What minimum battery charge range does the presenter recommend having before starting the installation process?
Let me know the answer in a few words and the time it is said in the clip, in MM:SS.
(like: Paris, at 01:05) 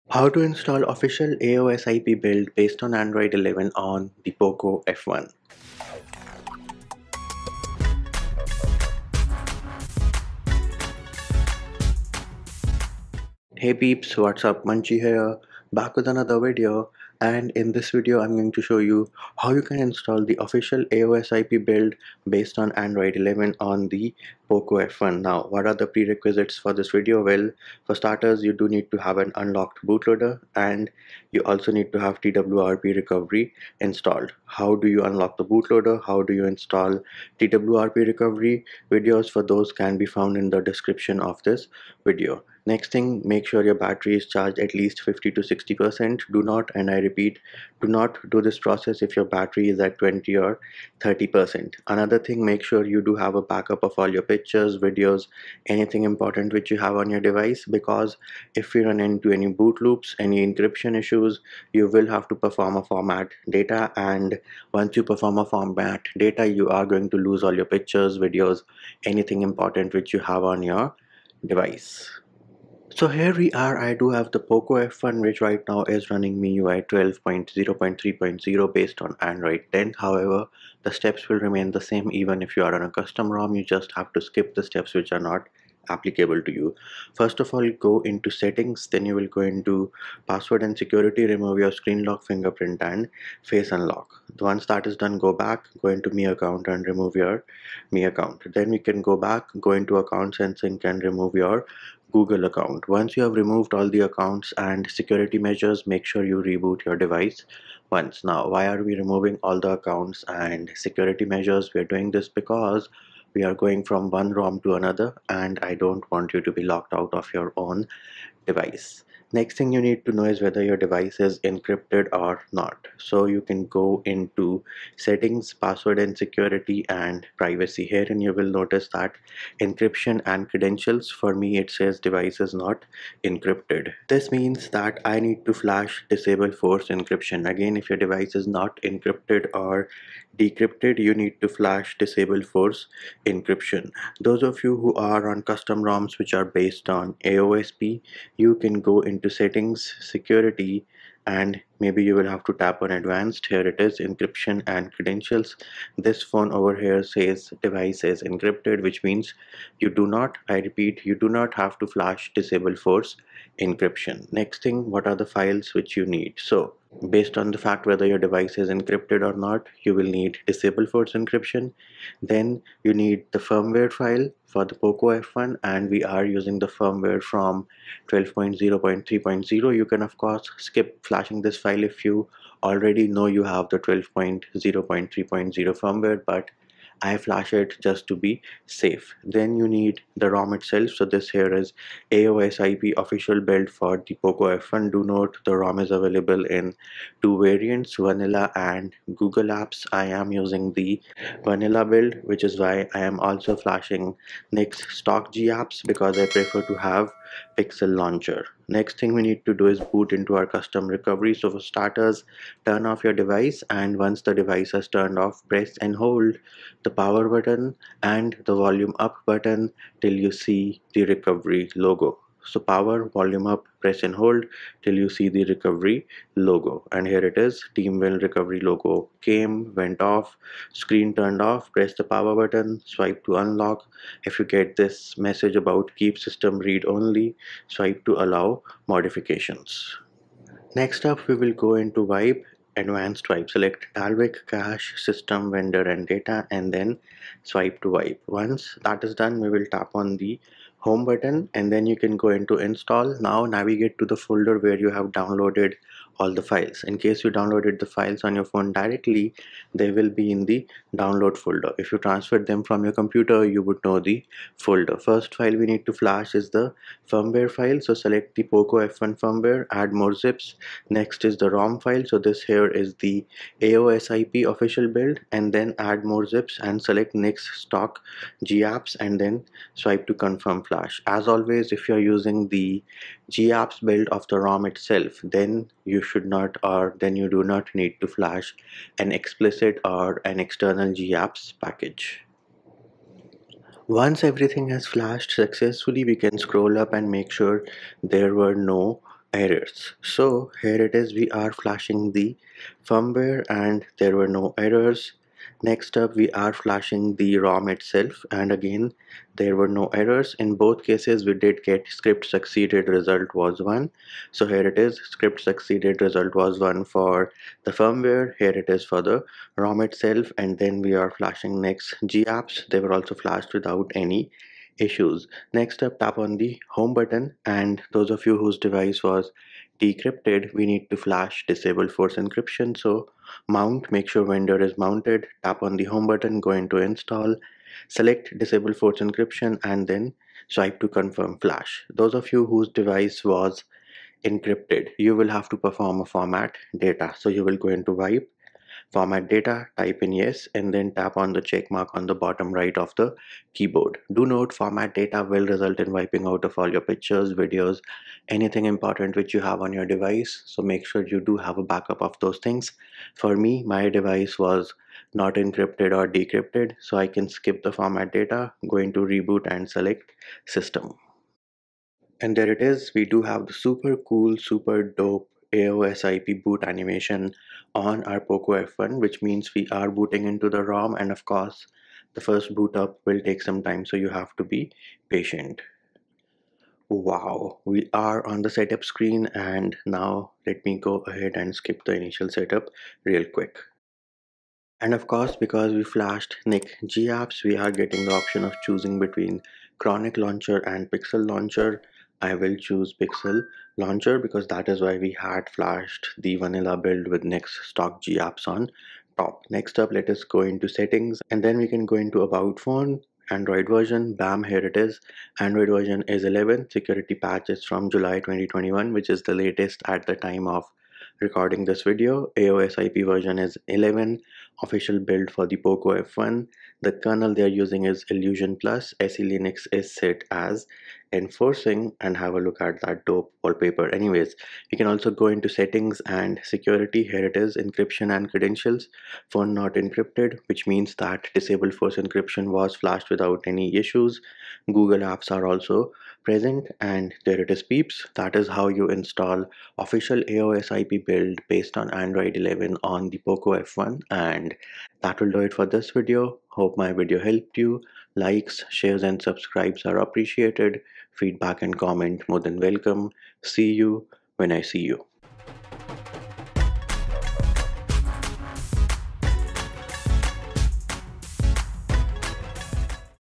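50 to 60%, at 00:45.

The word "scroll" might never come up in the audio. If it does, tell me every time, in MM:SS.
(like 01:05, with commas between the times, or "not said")
04:56.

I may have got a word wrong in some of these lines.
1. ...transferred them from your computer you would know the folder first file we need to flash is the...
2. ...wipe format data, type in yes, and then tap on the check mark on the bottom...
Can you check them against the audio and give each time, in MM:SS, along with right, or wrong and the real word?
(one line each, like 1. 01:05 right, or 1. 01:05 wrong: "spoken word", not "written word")
1. 04:21 right
2. 05:48 right.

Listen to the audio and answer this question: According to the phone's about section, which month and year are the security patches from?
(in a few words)
July 2021.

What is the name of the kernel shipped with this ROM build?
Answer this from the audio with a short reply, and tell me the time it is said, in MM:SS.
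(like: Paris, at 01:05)
Illusion Plus, at 07:08.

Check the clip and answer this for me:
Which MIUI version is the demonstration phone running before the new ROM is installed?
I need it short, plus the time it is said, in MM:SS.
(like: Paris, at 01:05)
MIUI 12.0.3.0, at 01:16.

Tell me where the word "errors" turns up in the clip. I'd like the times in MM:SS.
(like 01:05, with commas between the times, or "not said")
04:59, 05:04, 05:09.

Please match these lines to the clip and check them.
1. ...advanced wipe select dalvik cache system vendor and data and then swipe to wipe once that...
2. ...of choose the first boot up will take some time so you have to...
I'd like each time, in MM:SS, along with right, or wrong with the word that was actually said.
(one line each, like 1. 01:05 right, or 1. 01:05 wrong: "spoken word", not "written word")
1. 04:02 right
2. 06:21 wrong: "course", not "choose".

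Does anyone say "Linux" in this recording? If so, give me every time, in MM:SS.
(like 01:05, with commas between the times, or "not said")
07:09.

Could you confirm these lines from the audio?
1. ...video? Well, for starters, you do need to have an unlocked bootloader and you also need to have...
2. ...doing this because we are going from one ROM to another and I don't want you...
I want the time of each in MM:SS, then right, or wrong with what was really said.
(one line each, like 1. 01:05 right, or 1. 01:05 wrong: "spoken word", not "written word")
1. 00:26 right
2. 01:51 right.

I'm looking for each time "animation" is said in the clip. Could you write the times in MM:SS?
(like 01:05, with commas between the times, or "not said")
06:16.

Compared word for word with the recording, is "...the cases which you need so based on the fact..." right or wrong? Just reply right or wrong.
wrong.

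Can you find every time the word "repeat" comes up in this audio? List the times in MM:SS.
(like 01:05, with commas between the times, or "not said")
00:46, 02:40.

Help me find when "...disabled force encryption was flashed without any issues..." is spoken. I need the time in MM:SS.
07:21.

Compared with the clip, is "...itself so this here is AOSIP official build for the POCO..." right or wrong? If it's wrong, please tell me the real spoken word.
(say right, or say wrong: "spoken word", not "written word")
right.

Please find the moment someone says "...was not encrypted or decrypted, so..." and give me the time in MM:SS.
06:04.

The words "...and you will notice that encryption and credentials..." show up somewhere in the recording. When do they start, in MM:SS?
02:08.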